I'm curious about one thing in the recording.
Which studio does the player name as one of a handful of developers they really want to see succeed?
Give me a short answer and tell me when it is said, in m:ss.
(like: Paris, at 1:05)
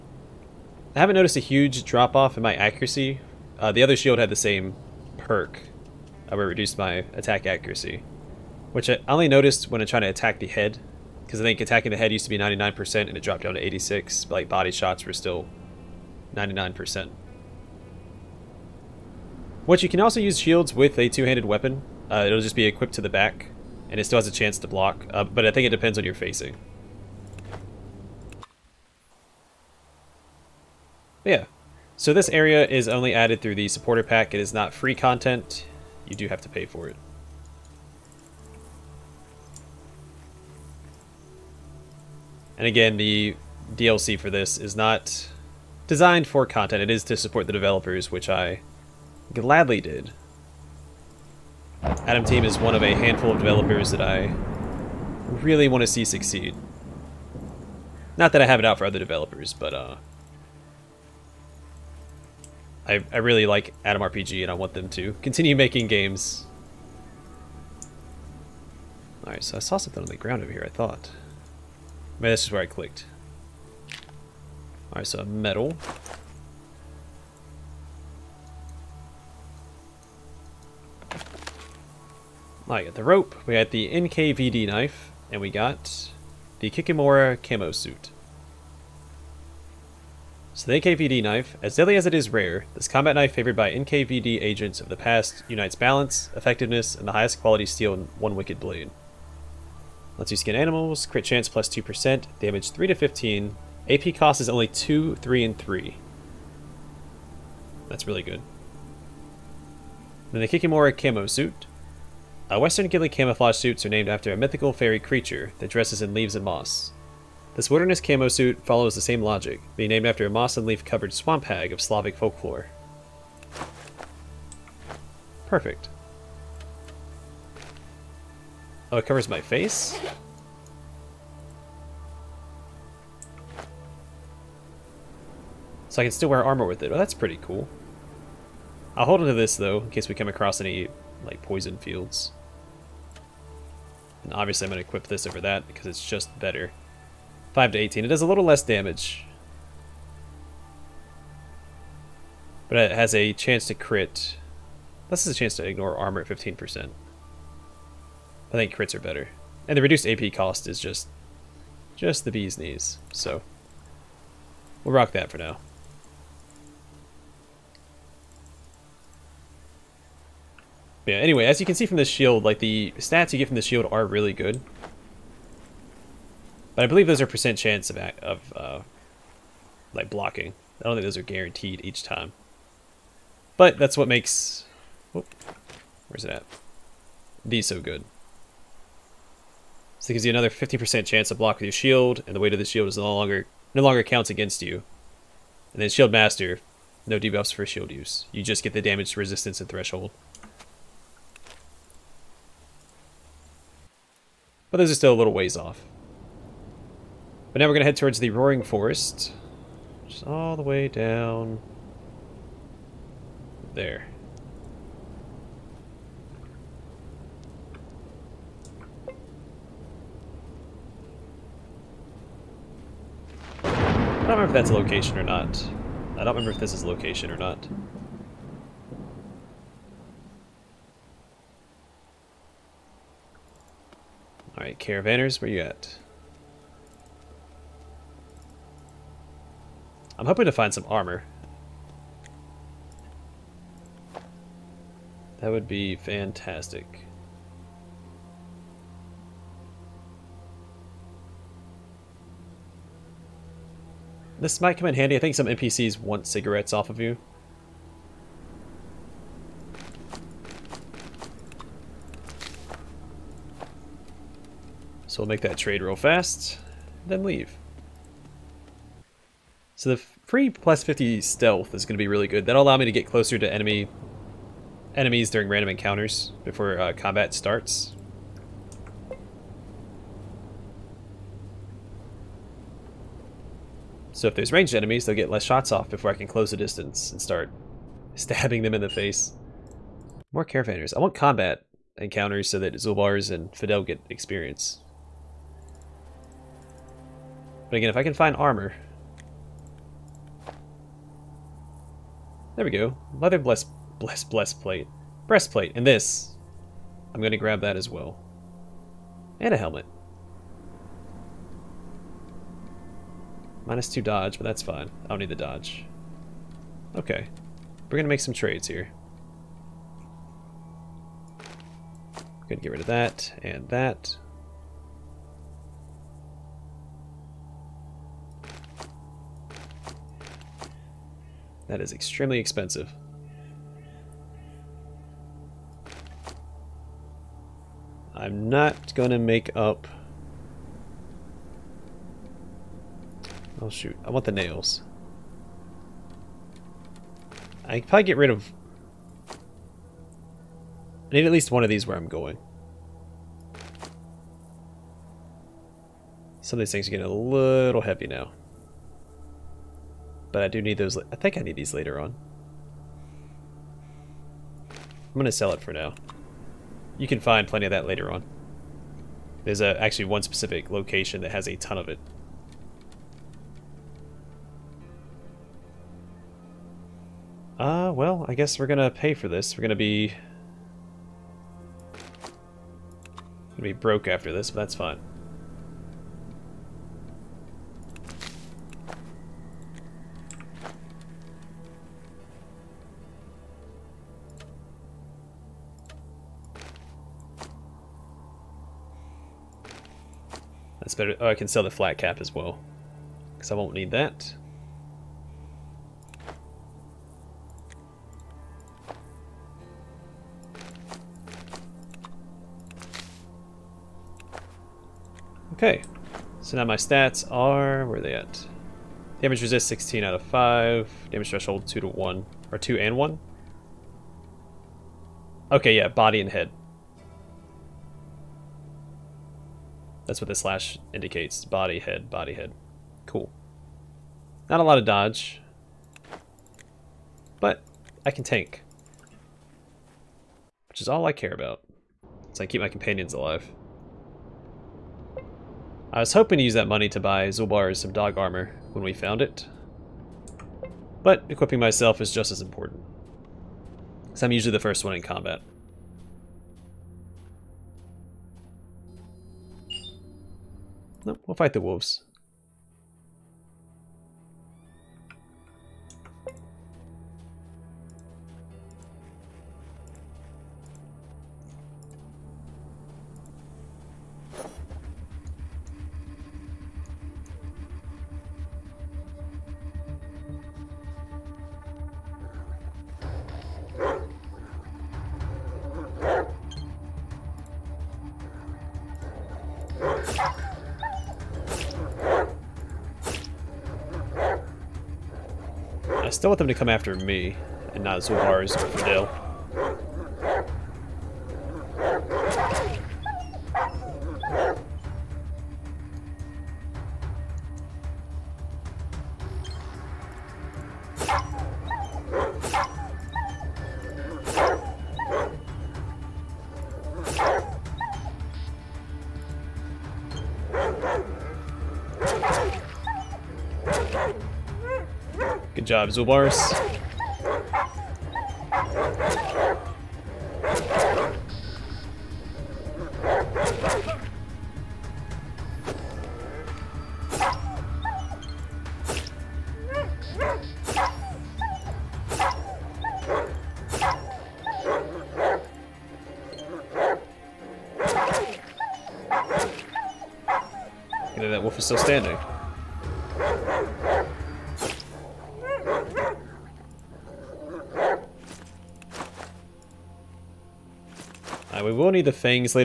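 Atom Team, at 0:51.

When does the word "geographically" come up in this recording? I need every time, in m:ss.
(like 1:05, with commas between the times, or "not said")
not said.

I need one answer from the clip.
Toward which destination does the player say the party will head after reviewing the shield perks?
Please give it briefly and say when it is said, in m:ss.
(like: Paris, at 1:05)
Roaring Forest, at 3:28.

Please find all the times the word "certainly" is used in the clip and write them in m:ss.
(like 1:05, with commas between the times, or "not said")
not said.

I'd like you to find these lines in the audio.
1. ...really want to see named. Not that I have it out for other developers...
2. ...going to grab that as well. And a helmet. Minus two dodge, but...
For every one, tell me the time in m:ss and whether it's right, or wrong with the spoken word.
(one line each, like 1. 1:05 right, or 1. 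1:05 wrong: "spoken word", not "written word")
1. 0:55 wrong: "succeed", not "named"
2. 5:07 right.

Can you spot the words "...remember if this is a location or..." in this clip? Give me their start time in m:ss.
3:46.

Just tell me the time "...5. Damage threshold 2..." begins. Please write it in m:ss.
7:00.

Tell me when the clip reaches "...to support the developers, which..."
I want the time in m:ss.
0:47.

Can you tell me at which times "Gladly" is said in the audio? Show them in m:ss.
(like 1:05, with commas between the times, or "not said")
0:49.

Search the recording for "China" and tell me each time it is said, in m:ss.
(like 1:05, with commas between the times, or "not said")
not said.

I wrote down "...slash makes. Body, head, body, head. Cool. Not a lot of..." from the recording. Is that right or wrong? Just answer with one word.
wrong.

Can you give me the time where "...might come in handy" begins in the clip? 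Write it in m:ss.
4:14.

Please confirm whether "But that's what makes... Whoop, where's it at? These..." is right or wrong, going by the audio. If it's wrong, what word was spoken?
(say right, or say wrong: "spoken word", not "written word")
right.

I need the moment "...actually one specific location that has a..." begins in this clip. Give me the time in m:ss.
6:09.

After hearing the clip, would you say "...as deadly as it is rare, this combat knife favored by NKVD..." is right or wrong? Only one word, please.
right.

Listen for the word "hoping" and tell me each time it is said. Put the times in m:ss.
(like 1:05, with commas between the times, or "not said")
4:00, 7:26.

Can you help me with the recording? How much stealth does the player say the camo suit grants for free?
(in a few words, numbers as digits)
50.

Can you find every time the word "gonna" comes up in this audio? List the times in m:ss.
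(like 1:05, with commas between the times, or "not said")
5:22, 5:38, 6:23.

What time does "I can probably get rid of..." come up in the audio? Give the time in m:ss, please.
5:47.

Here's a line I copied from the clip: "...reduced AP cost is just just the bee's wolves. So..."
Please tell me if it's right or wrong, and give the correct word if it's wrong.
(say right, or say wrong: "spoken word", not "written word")
wrong: "knees", not "wolves".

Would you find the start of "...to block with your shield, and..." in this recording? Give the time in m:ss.
3:11.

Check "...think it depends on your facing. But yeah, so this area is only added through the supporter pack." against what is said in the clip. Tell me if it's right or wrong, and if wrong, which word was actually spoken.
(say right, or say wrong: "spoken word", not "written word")
right.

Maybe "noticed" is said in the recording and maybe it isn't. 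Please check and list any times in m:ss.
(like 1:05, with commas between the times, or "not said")
0:01, 0:09.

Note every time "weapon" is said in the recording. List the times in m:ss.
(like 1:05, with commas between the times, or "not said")
0:21.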